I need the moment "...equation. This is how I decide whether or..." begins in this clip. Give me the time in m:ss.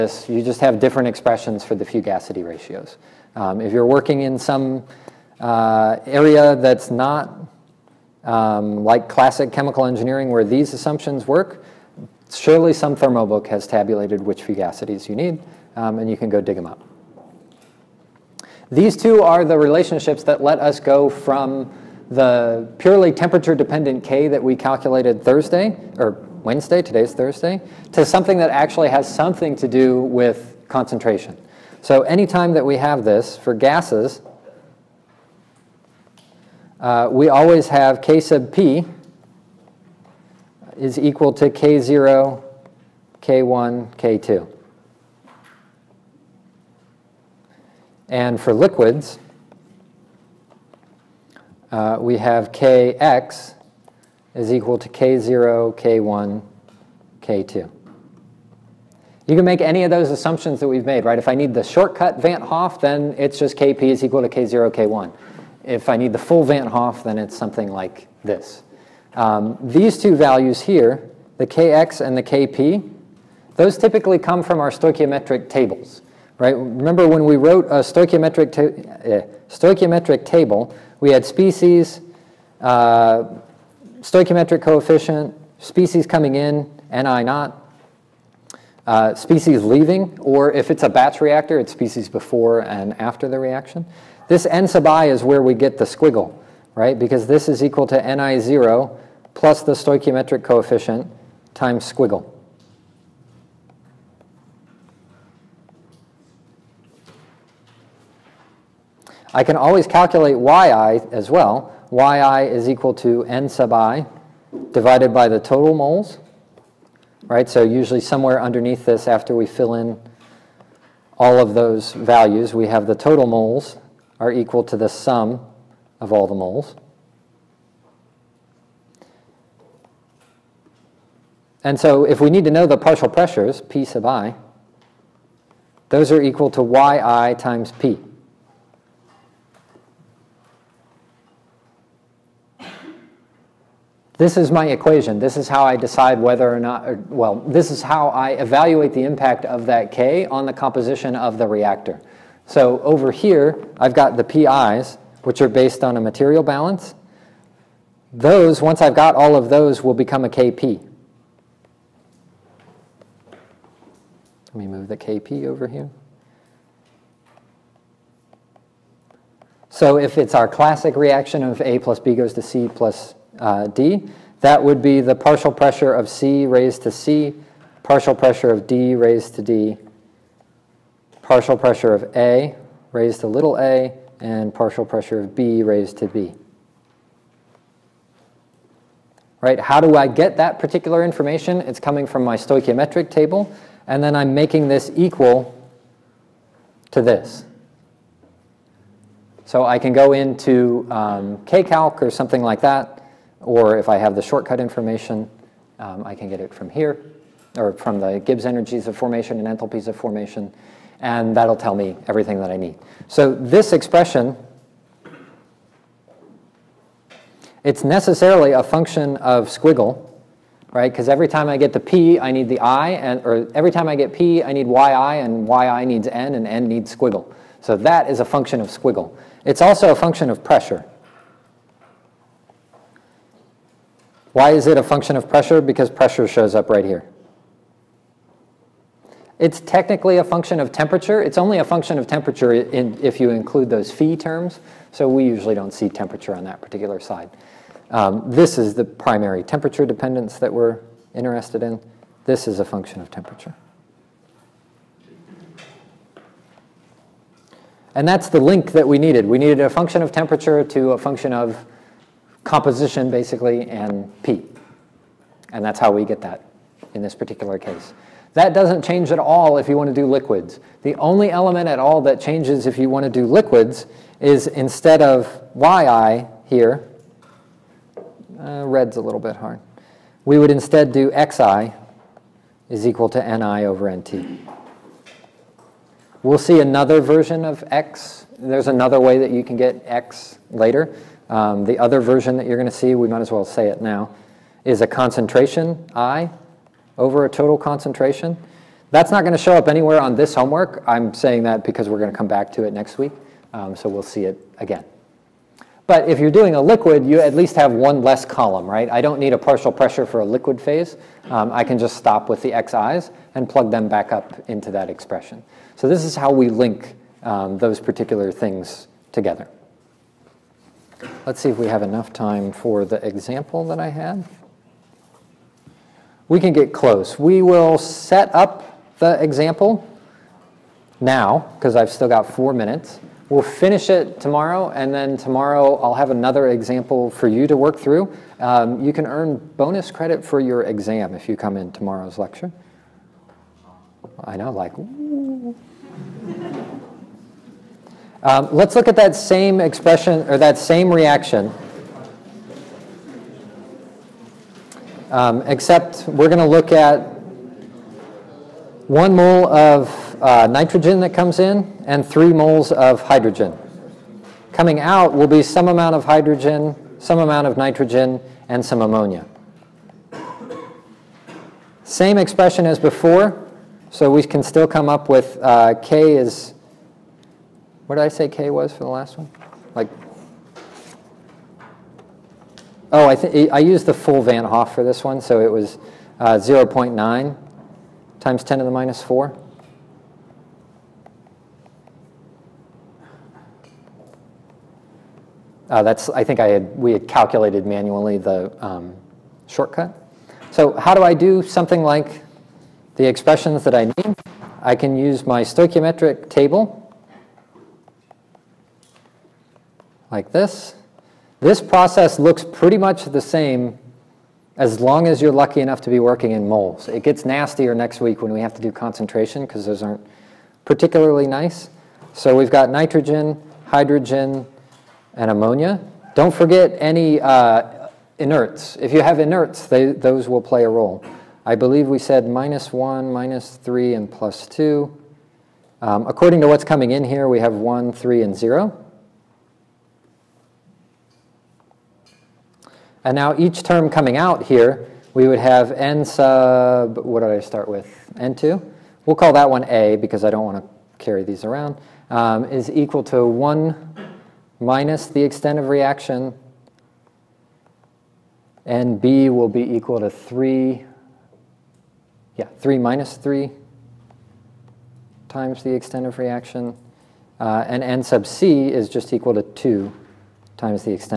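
2:24.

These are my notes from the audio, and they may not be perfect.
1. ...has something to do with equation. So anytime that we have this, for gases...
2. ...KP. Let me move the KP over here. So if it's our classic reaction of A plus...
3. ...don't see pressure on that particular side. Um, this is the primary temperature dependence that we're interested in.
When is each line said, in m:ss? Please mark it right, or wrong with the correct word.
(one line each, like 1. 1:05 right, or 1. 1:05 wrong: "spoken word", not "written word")
1. 0:28 wrong: "concentration", not "equation"
2. 2:40 right
3. 4:05 wrong: "temperature", not "pressure".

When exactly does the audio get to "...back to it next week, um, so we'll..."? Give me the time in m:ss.
5:02.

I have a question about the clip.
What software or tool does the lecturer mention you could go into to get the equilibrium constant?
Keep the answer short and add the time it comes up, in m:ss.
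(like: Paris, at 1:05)
KCalc, at 3:21.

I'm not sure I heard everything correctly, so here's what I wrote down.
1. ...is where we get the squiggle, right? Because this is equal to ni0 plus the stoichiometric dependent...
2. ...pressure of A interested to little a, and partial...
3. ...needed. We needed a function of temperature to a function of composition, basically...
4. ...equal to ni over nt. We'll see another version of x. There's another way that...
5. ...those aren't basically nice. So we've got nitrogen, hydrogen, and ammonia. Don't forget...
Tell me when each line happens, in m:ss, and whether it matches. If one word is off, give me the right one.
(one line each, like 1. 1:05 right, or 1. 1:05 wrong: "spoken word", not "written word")
1. 1:35 wrong: "coefficient", not "dependent"
2. 3:01 wrong: "raised", not "interested"
3. 4:18 right
4. 4:42 right
5. 6:59 wrong: "particularly", not "basically".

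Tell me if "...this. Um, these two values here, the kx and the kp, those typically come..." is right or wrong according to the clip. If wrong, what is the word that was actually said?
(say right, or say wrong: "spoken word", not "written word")
right.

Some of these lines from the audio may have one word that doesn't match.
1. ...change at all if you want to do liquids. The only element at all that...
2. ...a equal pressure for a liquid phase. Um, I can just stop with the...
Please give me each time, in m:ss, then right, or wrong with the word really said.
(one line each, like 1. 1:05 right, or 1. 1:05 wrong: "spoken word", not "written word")
1. 4:28 right
2. 5:09 wrong: "partial", not "equal".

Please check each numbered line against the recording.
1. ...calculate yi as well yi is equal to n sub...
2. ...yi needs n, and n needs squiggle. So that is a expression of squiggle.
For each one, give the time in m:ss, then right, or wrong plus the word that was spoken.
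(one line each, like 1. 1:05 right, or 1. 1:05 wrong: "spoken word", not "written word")
1. 1:49 right
2. 3:45 wrong: "function", not "expression".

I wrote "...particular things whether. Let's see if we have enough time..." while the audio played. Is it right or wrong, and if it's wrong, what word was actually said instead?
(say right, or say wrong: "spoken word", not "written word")
wrong: "together", not "whether".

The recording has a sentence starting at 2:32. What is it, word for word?
So over here, I've got the PIs, which are based on a material balance.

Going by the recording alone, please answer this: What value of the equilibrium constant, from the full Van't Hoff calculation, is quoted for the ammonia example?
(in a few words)
0.9 × 10^-4.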